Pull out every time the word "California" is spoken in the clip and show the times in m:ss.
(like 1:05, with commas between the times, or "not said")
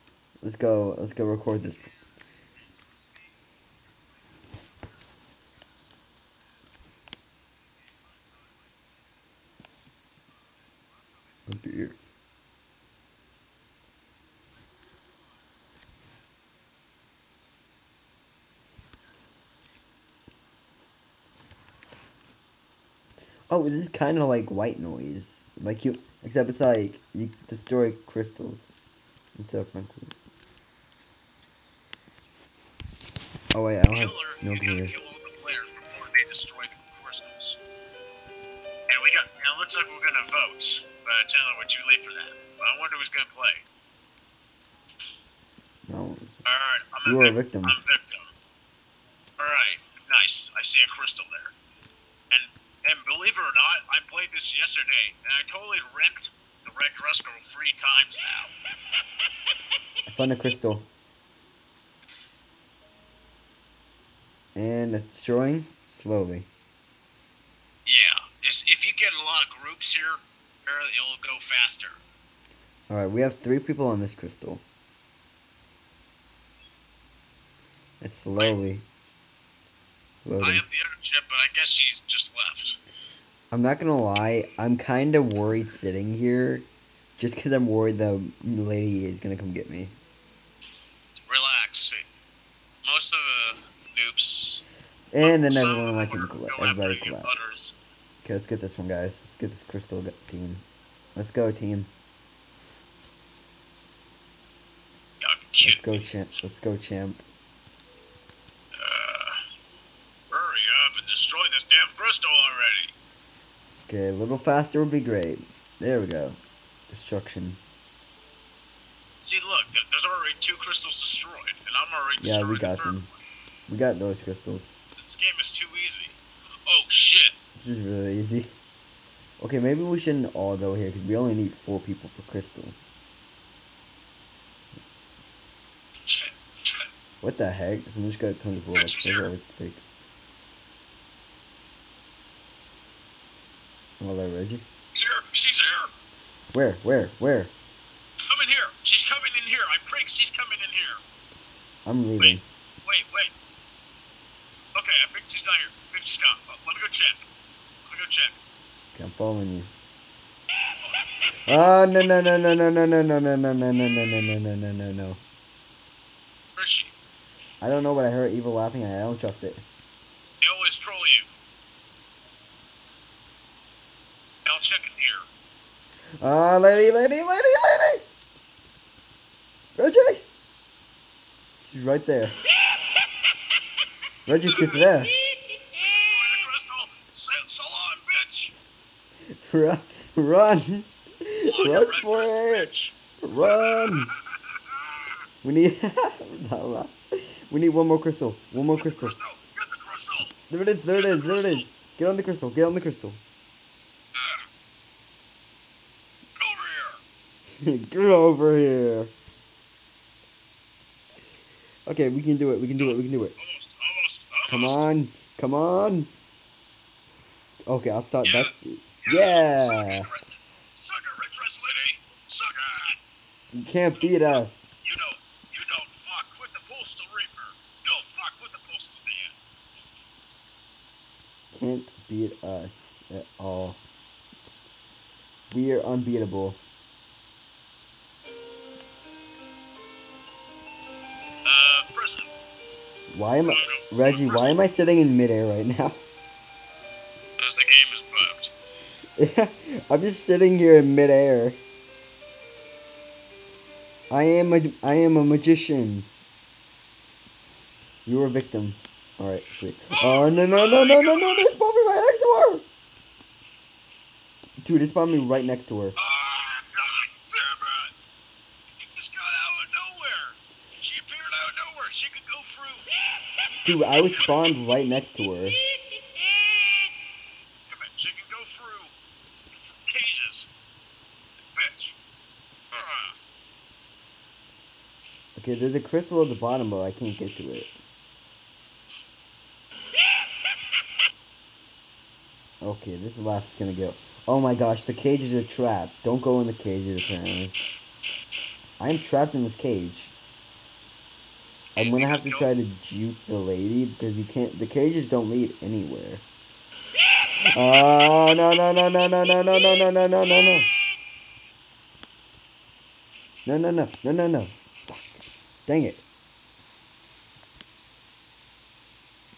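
not said.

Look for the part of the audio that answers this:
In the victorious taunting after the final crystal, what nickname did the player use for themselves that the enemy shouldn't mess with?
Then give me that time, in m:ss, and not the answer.
3:46.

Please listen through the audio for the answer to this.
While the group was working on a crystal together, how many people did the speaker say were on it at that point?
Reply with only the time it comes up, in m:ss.
1:13.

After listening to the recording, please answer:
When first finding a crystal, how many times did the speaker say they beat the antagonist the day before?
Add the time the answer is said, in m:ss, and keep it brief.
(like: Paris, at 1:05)
3, at 0:57.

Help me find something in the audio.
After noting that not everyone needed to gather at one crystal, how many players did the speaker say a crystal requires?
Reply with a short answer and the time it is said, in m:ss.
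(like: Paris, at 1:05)
4, at 2:11.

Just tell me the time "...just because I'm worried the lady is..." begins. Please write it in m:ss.
1:27.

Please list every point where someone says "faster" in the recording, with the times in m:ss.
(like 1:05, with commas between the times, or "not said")
1:11, 1:54.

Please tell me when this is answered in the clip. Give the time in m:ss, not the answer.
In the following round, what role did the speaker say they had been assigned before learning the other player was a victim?
4:15.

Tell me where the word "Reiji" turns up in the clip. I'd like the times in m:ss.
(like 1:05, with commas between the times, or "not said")
2:24, 2:59, 3:04, 4:03.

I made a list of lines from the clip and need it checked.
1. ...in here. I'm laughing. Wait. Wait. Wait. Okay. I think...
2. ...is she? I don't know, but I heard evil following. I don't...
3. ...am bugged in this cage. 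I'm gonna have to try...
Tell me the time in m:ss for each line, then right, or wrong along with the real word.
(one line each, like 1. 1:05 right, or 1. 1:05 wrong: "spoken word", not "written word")
1. 2:30 wrong: "leaving", not "laughing"
2. 2:46 wrong: "laughing", not "following"
3. 4:58 wrong: "trapped", not "bugged".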